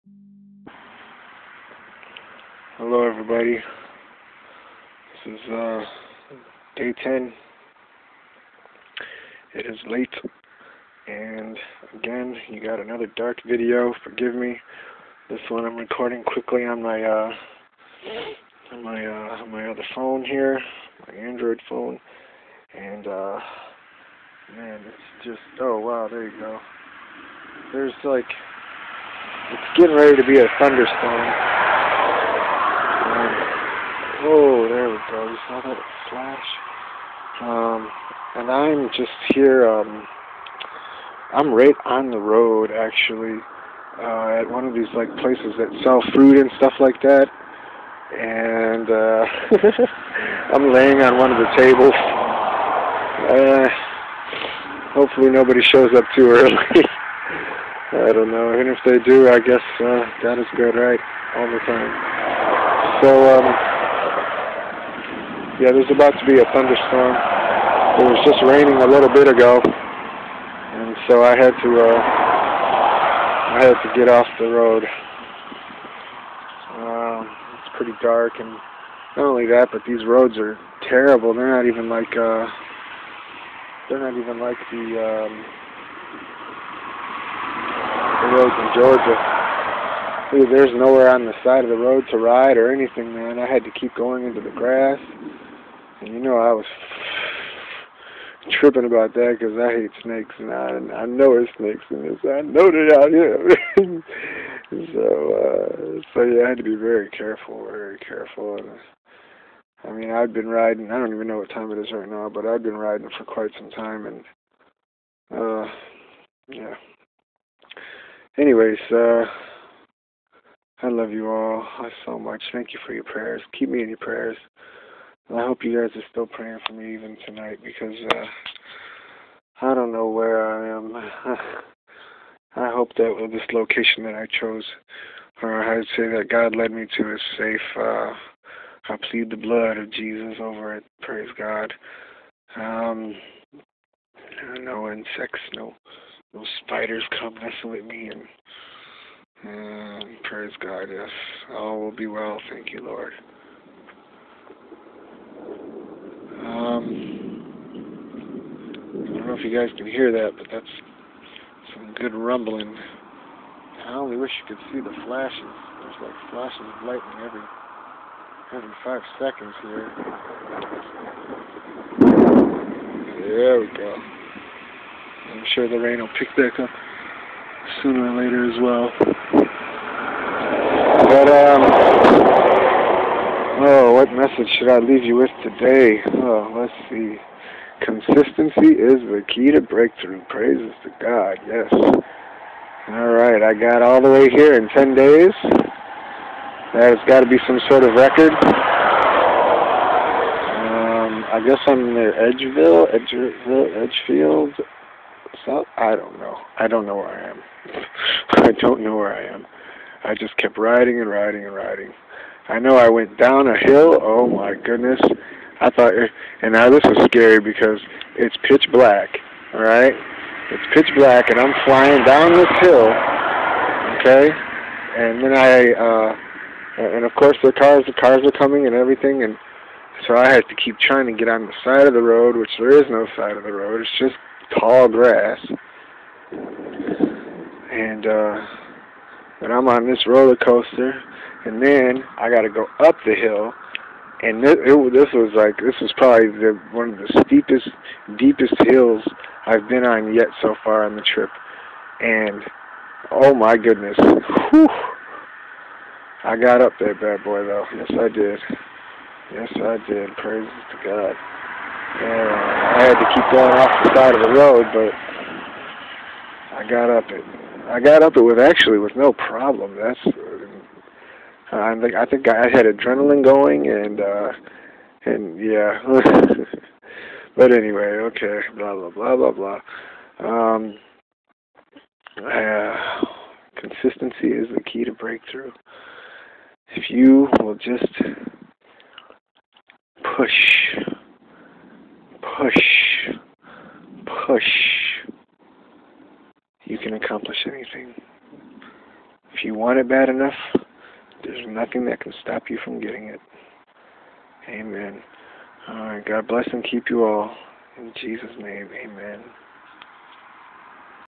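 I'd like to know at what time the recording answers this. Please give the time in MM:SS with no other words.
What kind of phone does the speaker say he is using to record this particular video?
00:21.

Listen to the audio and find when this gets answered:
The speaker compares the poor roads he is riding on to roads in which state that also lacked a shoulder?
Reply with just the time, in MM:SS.
01:28.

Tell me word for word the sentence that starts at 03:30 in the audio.
I just kept riding and riding and riding.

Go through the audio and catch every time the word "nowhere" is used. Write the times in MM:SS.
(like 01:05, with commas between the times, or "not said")
01:30.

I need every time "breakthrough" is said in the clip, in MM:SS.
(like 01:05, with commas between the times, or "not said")
03:09, 04:44.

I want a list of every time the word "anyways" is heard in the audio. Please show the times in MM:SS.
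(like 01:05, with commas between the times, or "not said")
01:58, 04:37.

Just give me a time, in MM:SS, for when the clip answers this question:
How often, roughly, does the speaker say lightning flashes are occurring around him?
02:47.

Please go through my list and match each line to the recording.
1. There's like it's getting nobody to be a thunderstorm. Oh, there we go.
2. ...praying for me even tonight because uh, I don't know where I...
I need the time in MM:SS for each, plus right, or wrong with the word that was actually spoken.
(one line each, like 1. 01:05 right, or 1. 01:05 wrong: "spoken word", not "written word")
1. 00:27 wrong: "ready", not "nobody"
2. 02:06 right.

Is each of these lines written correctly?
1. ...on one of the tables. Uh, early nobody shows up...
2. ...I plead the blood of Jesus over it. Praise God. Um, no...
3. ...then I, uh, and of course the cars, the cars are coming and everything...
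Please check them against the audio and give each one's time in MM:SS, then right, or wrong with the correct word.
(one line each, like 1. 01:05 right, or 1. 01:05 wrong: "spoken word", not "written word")
1. 00:51 wrong: "hopefully", not "early"
2. 02:18 right
3. 03:45 right.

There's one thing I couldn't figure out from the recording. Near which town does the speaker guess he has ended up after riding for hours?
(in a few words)
Edgefield.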